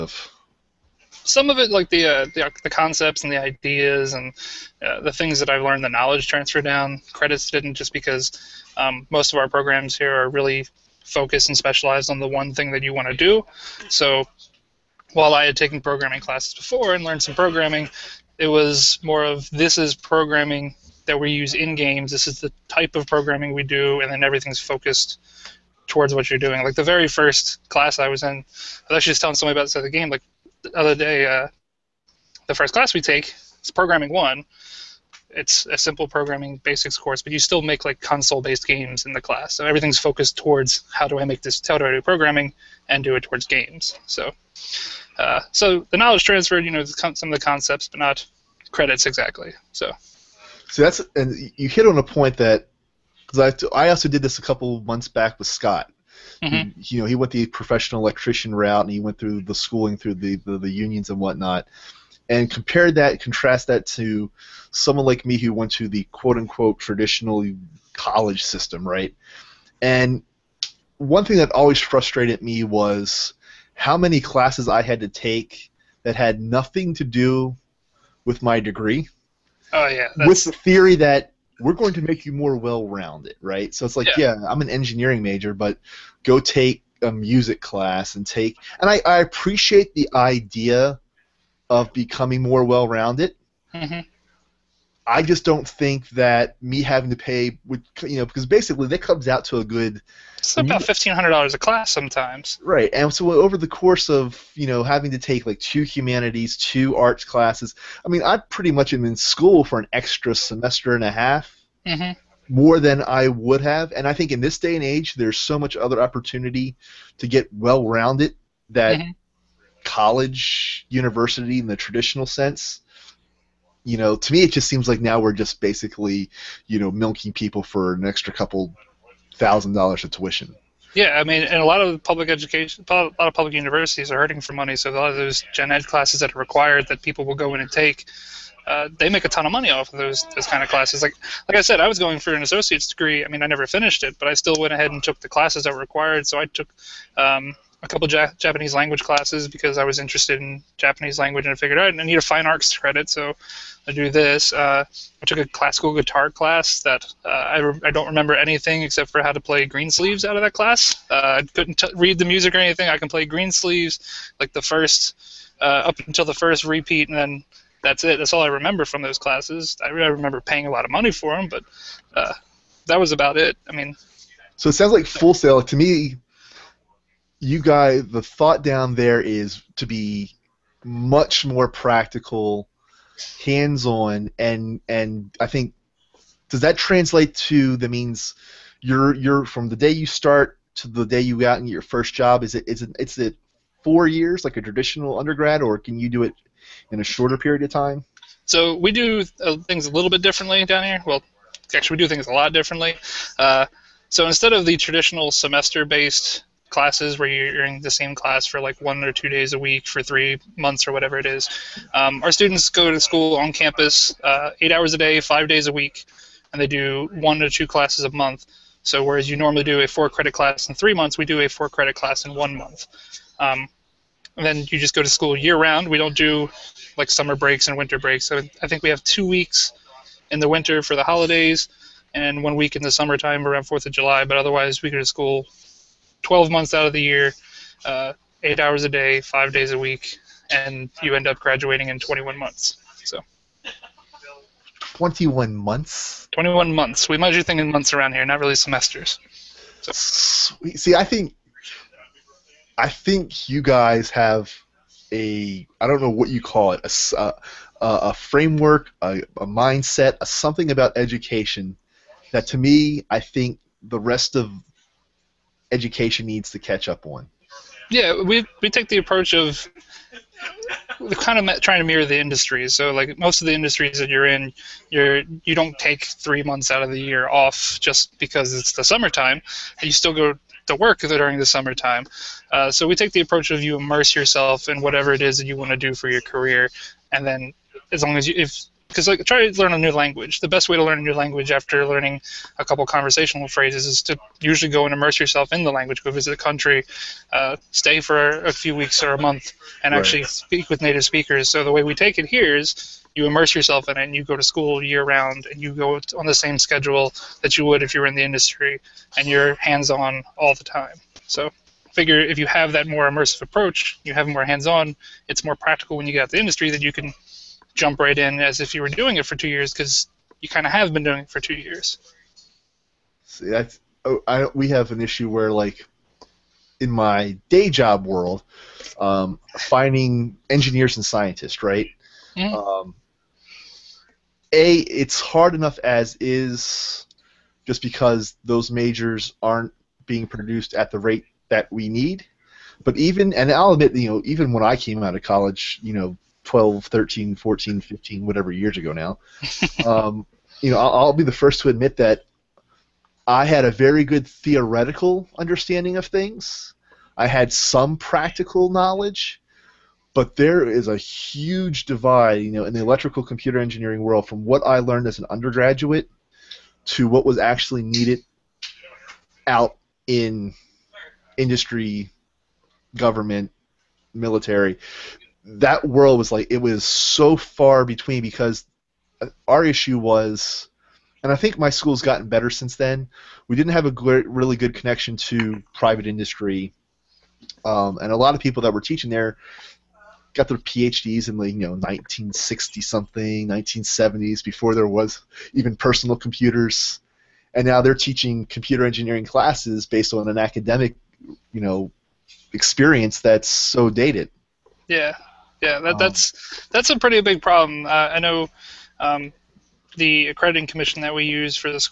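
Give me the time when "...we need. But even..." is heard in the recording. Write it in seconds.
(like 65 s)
341 s.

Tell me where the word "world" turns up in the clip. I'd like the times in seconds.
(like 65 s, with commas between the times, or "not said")
328 s, 364 s, 375 s.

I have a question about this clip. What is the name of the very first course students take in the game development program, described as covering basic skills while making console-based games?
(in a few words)
Programming one.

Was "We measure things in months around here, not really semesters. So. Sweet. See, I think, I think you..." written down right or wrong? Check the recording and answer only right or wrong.
right.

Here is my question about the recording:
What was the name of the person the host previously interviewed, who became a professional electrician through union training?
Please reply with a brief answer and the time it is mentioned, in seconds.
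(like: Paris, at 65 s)
Scott, at 55 s.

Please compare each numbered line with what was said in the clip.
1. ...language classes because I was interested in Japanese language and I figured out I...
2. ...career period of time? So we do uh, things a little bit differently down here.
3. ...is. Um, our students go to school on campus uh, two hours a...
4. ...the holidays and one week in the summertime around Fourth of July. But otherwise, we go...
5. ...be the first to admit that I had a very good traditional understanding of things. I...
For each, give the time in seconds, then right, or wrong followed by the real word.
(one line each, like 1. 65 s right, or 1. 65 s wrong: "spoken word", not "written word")
1. 148 s right
2. 197 s wrong: "shorter", not "career"
3. 211 s wrong: "eight", not "two"
4. 230 s right
5. 351 s wrong: "theoretical", not "traditional".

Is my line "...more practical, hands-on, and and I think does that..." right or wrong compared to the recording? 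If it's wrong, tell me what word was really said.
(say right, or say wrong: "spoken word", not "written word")
right.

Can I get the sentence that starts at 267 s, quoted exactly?
Yeah, we we take the approach of kind of trying to mirror the industry.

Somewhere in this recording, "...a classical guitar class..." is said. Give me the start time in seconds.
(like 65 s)
155 s.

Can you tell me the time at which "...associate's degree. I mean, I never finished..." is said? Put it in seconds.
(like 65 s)
142 s.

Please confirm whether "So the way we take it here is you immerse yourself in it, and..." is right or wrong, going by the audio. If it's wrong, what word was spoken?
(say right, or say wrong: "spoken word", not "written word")
right.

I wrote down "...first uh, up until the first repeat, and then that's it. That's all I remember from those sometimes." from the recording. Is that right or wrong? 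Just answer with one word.
wrong.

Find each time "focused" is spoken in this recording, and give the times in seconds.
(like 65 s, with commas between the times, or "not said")
11 s, 24 s, 39 s.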